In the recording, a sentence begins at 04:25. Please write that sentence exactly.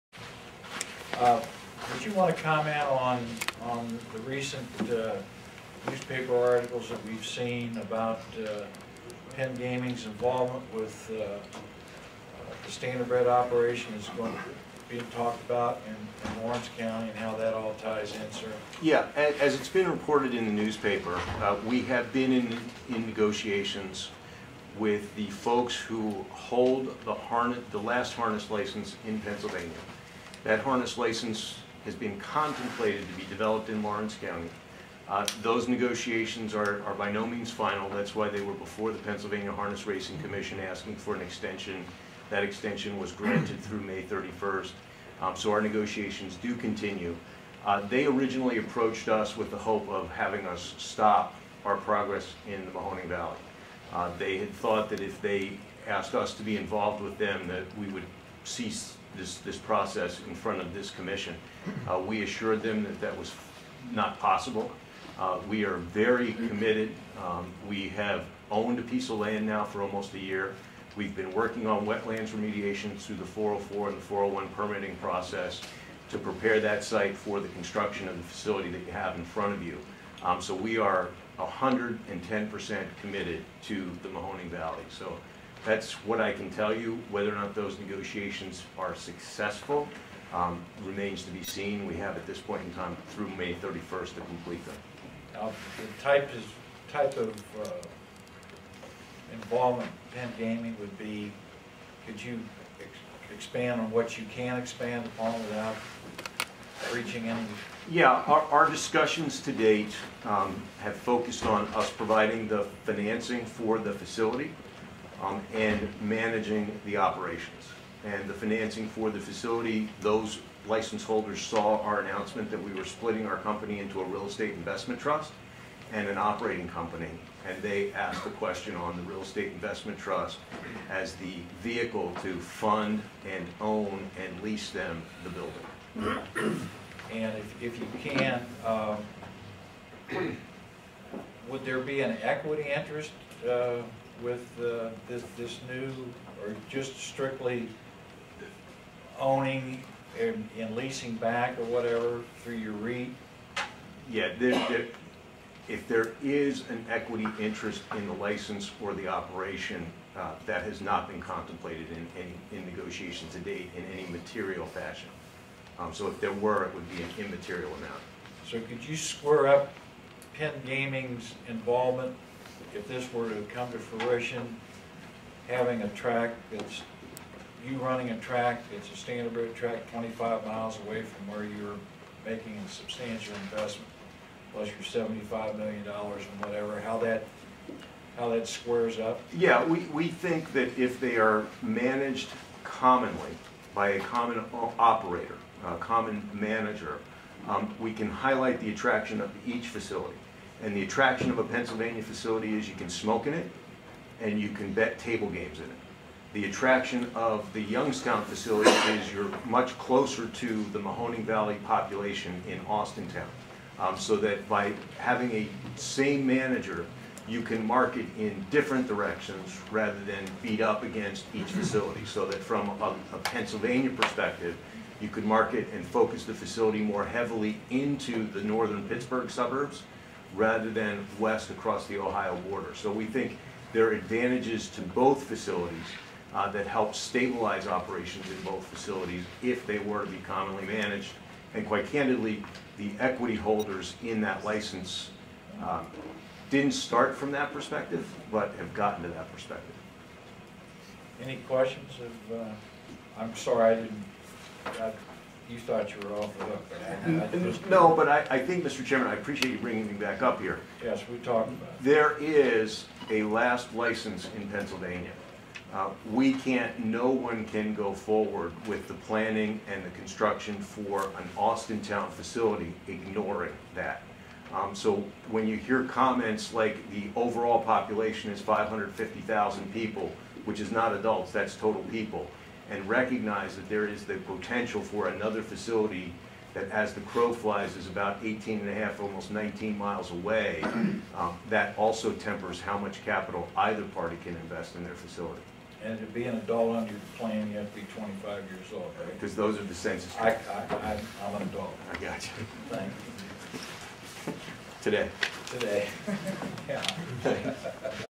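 Uh, We can't, no one can go forward with the planning and the construction for an Austintown facility ignoring that.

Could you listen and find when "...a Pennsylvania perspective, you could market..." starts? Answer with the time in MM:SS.
03:43.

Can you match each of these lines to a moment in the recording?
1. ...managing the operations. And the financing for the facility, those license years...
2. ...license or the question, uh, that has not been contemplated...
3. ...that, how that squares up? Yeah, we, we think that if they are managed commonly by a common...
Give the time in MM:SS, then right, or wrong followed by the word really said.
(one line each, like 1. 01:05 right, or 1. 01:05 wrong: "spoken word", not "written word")
1. 01:56 wrong: "holders", not "years"
2. 02:38 wrong: "operation", not "question"
3. 03:06 right.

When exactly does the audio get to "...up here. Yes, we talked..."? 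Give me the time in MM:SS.
04:20.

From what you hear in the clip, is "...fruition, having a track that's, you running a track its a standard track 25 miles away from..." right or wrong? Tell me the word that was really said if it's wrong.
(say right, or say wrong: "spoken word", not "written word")
right.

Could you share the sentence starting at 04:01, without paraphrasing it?
And quite candidly, the equity holders in that license um, didn't start from that perspective, but have gotten to that perspective.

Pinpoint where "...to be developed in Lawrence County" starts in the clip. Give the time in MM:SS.
00:33.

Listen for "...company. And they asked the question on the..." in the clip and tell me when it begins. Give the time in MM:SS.
02:06.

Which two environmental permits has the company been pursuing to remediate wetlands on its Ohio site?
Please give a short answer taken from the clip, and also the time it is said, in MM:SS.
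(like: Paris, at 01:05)
404 and 401, at 01:13.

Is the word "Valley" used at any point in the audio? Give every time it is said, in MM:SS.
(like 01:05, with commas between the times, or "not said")
00:53, 01:24, 03:31.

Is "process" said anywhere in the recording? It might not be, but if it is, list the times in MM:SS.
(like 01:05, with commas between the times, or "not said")
00:59, 01:14.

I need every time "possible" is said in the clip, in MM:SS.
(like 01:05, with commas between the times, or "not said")
01:04.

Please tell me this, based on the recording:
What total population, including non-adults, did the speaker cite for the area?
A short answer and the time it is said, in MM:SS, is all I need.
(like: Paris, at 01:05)
550,000, at 04:38.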